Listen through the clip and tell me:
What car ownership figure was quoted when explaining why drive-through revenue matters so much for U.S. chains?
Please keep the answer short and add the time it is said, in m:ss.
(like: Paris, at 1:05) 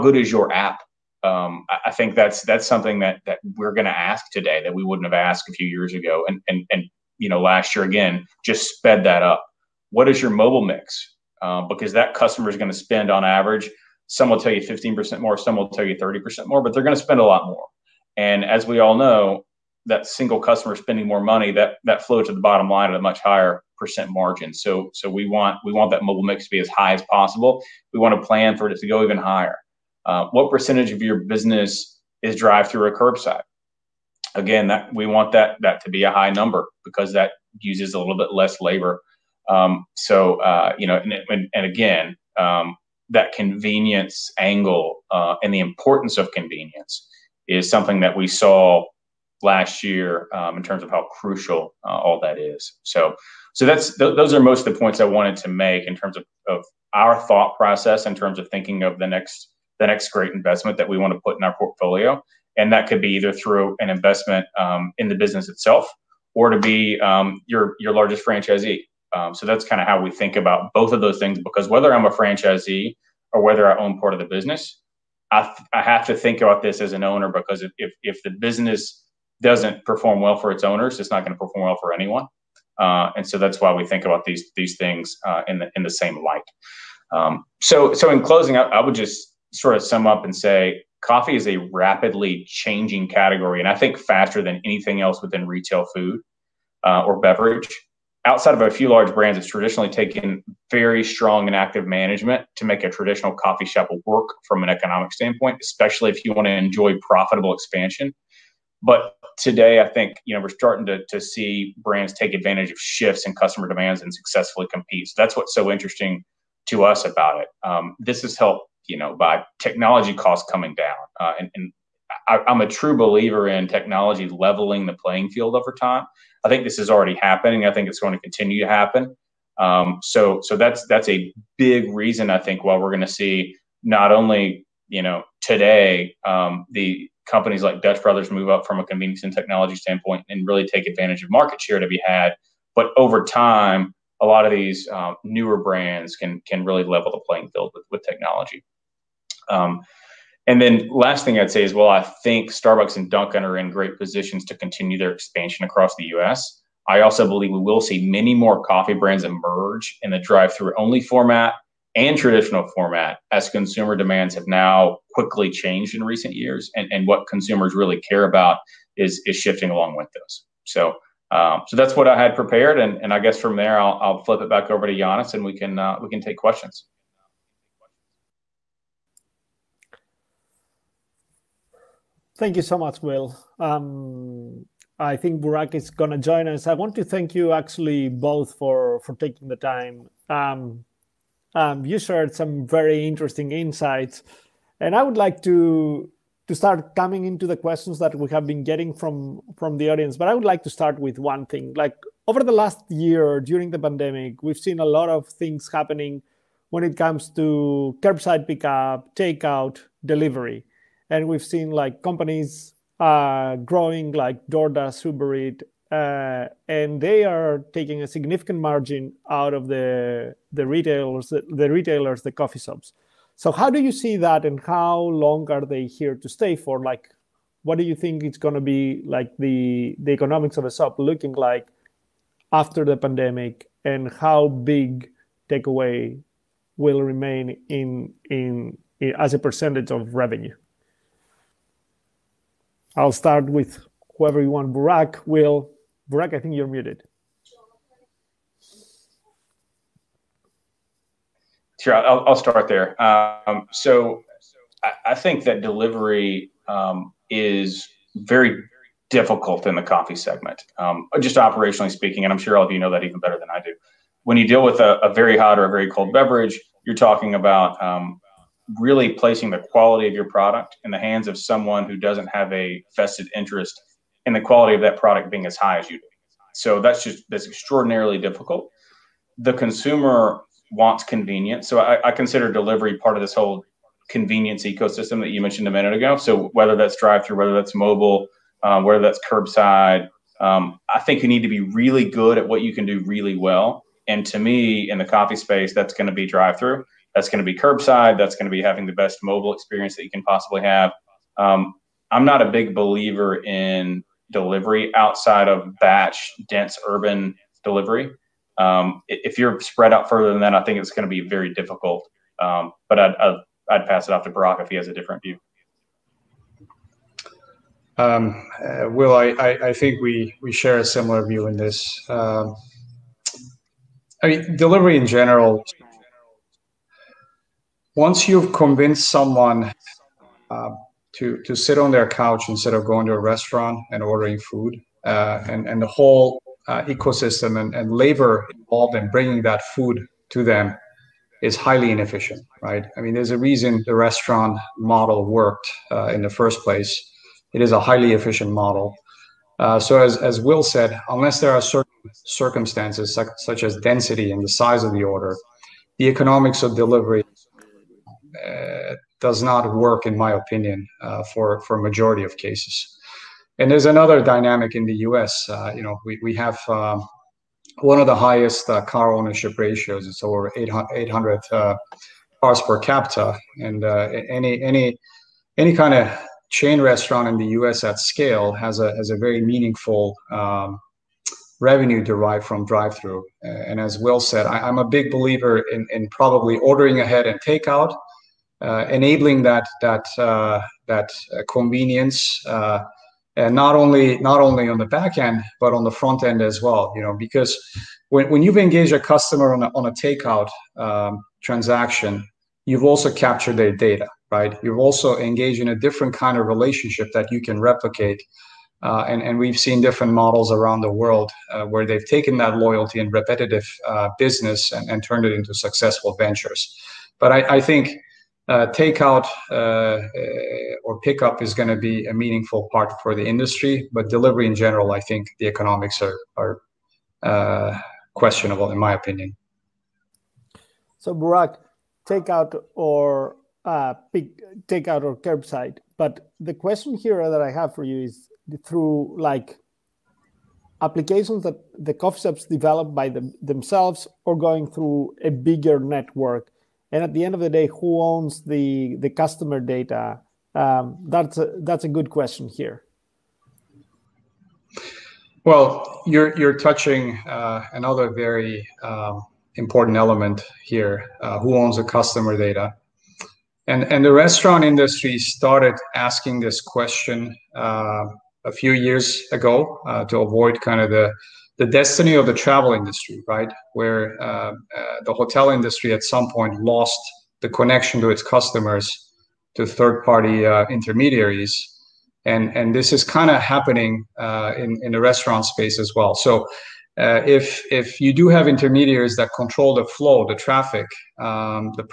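over 800, at 6:10.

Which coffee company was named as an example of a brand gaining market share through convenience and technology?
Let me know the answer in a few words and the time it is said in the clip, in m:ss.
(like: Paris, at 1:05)
Dutch Brothers, at 2:17.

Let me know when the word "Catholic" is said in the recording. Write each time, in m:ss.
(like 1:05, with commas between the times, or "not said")
not said.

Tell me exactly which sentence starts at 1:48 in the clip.
But today, I think you know we're starting to, to see brands take advantage of shifts in customer demands and successfully compete.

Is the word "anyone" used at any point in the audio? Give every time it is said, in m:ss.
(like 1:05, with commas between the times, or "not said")
1:21.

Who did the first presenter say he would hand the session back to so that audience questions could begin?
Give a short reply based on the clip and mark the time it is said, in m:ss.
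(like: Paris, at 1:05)
Giannis, at 2:54.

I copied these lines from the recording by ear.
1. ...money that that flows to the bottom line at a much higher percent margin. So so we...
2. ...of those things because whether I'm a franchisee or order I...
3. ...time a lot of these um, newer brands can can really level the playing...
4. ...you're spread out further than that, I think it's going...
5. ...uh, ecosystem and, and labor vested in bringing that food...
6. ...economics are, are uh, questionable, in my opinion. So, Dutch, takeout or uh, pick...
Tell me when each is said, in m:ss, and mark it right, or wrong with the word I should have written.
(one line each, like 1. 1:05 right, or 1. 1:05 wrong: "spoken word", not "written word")
1. 0:21 right
2. 1:10 wrong: "whether", not "order"
3. 2:23 right
4. 5:09 right
5. 5:36 wrong: "involved", not "vested"
6. 7:05 wrong: "Burak", not "Dutch".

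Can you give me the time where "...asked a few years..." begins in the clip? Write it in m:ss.
0:05.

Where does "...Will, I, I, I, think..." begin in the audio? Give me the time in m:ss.
5:18.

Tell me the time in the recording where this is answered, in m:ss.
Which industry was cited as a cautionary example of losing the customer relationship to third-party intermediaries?
7:55.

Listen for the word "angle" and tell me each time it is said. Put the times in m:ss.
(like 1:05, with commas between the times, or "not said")
0:44.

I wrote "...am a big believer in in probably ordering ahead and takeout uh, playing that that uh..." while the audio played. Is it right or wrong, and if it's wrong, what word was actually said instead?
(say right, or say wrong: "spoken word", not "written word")
wrong: "enabling", not "playing".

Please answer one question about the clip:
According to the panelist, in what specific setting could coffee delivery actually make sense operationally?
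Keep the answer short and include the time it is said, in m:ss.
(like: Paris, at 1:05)
batch dense urban delivery, at 5:05.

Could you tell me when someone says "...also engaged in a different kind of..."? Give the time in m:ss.
6:44.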